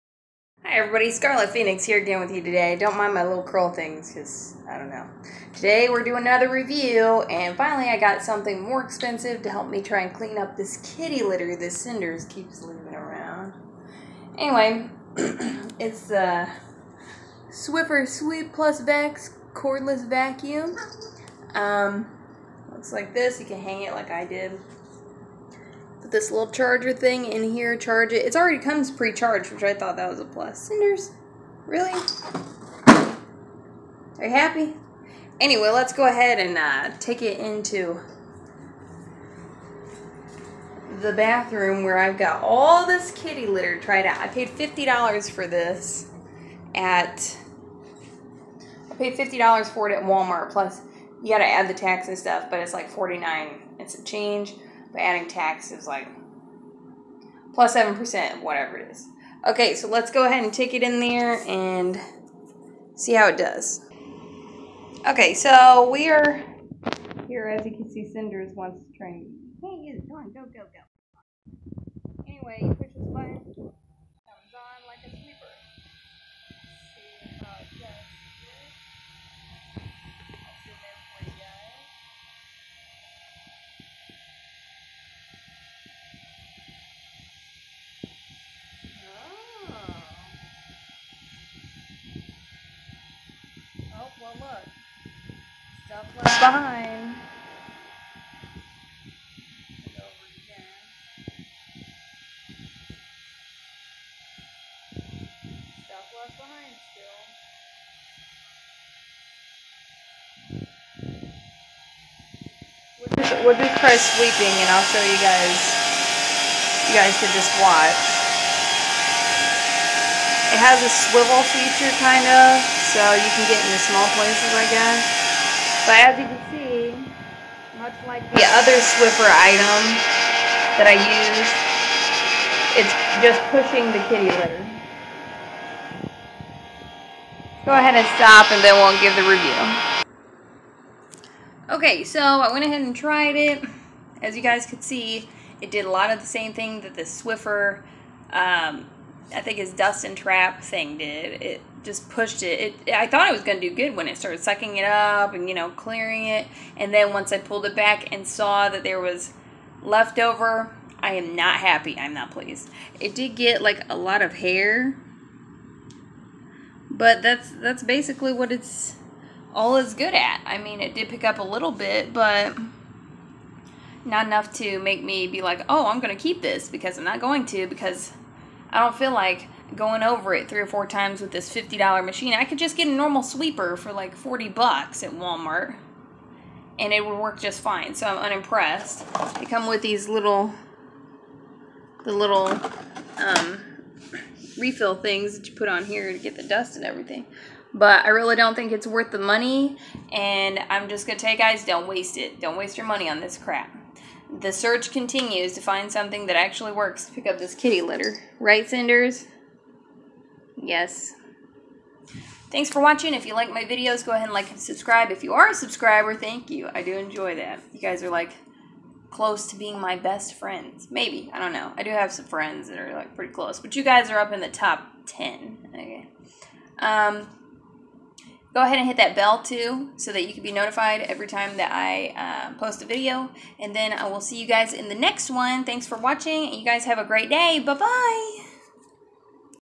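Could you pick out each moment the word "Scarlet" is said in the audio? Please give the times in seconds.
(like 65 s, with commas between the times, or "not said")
1 s.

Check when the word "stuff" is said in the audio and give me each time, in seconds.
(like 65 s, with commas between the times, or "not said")
52 s, 95 s, 105 s.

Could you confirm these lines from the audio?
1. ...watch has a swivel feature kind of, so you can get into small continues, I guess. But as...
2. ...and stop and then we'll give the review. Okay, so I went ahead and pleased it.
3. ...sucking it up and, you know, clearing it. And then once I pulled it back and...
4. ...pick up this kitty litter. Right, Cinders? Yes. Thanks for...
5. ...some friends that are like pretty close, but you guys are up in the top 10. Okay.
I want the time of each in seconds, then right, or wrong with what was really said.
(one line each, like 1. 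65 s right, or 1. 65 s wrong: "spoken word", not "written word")
1. 117 s wrong: "places", not "continues"
2. 137 s wrong: "tried", not "pleased"
3. 154 s right
4. 207 s right
5. 222 s right.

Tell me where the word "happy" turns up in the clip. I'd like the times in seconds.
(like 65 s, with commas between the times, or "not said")
34 s, 161 s.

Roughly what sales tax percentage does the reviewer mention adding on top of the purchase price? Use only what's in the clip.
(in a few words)
7%.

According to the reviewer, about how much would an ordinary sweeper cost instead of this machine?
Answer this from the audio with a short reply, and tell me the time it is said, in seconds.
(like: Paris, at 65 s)
$40, at 184 s.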